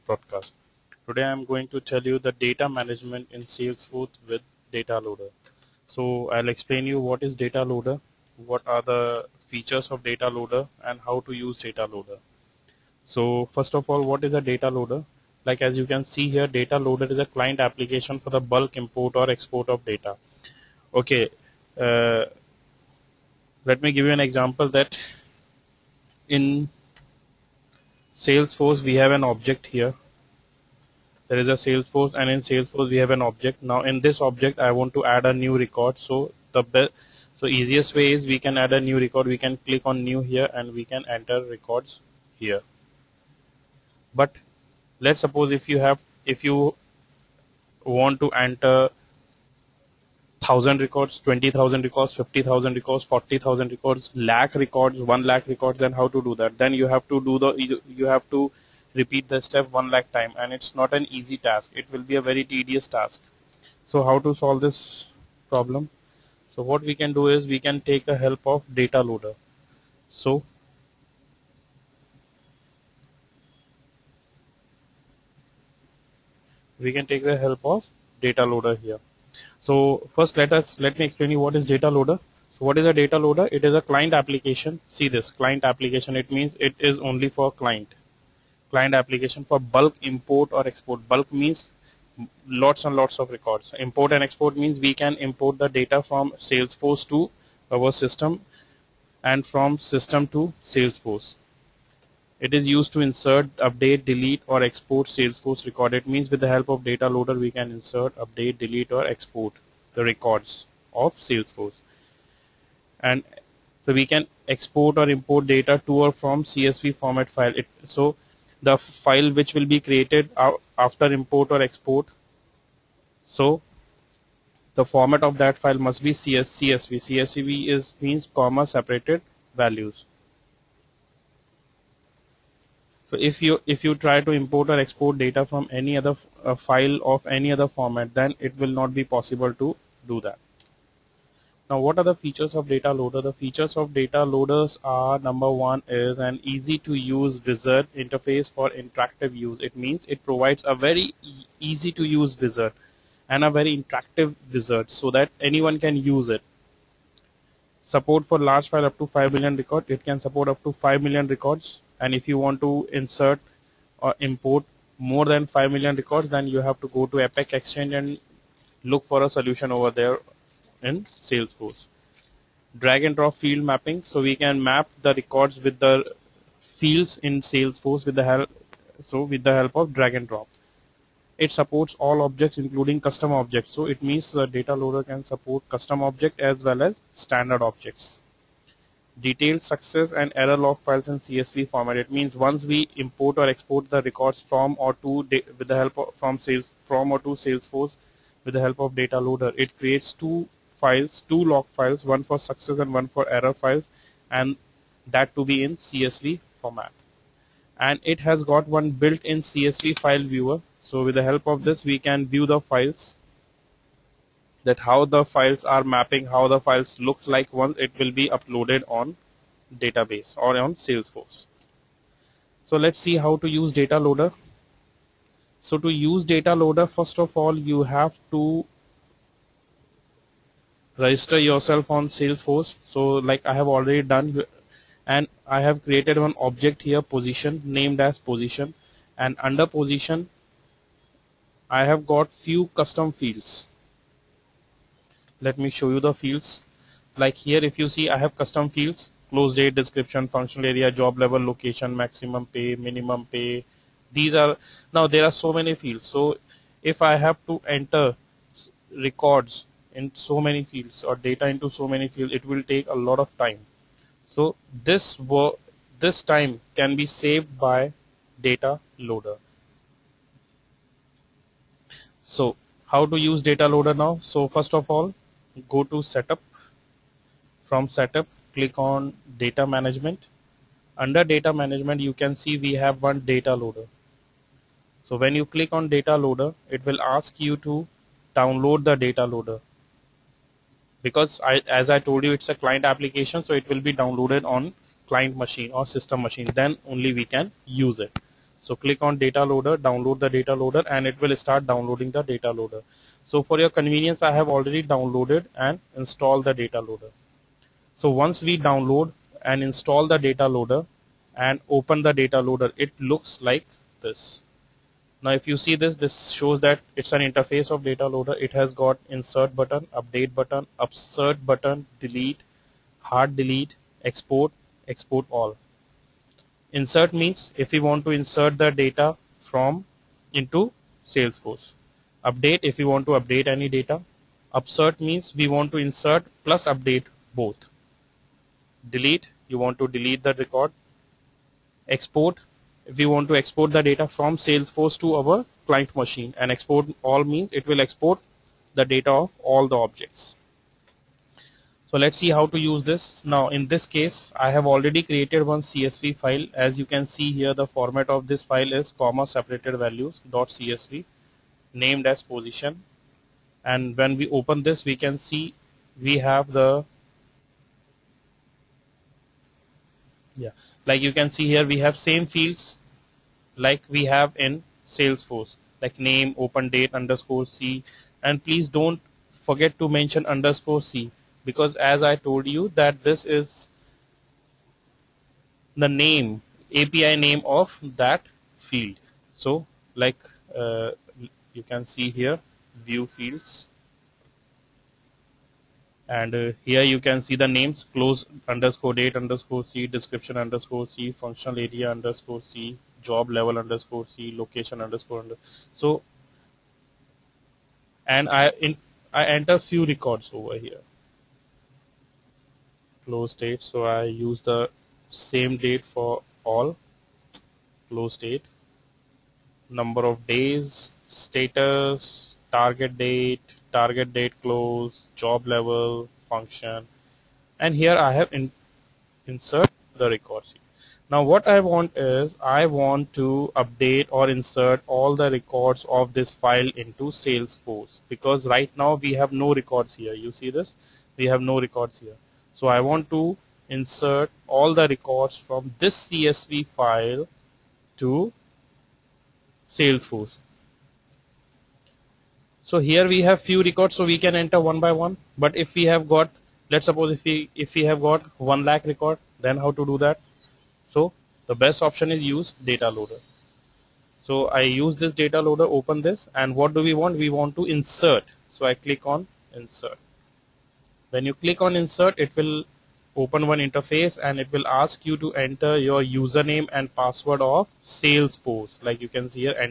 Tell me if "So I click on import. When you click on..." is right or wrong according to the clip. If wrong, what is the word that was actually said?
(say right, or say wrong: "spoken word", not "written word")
wrong: "insert", not "import".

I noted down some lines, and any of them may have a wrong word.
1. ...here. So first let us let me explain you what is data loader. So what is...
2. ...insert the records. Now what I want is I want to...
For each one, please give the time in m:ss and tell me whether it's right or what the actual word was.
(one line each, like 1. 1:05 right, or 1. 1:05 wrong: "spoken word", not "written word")
1. 1:18 right
2. 7:09 right.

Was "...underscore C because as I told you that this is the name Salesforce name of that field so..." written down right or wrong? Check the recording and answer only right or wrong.
wrong.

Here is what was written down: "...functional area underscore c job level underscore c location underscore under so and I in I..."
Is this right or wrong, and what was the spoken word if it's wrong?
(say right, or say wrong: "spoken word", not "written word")
right.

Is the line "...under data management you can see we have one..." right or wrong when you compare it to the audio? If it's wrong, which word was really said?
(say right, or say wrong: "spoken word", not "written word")
right.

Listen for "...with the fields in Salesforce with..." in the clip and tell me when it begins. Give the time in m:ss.
2:55.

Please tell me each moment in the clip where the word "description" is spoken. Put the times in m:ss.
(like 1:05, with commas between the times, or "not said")
4:09, 6:39.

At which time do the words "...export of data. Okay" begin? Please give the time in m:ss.
0:19.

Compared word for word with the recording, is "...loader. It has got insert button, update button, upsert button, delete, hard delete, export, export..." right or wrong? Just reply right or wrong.
right.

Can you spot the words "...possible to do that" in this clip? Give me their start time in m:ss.
2:19.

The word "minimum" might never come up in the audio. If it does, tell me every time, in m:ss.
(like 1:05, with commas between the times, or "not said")
4:12.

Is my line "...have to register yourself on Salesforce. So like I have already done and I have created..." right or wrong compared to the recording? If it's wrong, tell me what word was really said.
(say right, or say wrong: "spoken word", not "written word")
right.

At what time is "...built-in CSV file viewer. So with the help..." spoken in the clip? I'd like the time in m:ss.
3:28.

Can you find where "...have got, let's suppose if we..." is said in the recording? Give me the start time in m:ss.
7:35.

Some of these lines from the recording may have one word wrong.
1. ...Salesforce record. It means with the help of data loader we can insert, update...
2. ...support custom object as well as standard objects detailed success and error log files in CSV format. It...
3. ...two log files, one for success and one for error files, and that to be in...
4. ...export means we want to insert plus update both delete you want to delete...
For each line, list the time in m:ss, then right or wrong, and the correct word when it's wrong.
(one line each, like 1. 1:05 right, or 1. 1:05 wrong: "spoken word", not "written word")
1. 1:45 right
2. 3:05 right
3. 3:21 right
4. 5:34 wrong: "upsert", not "export".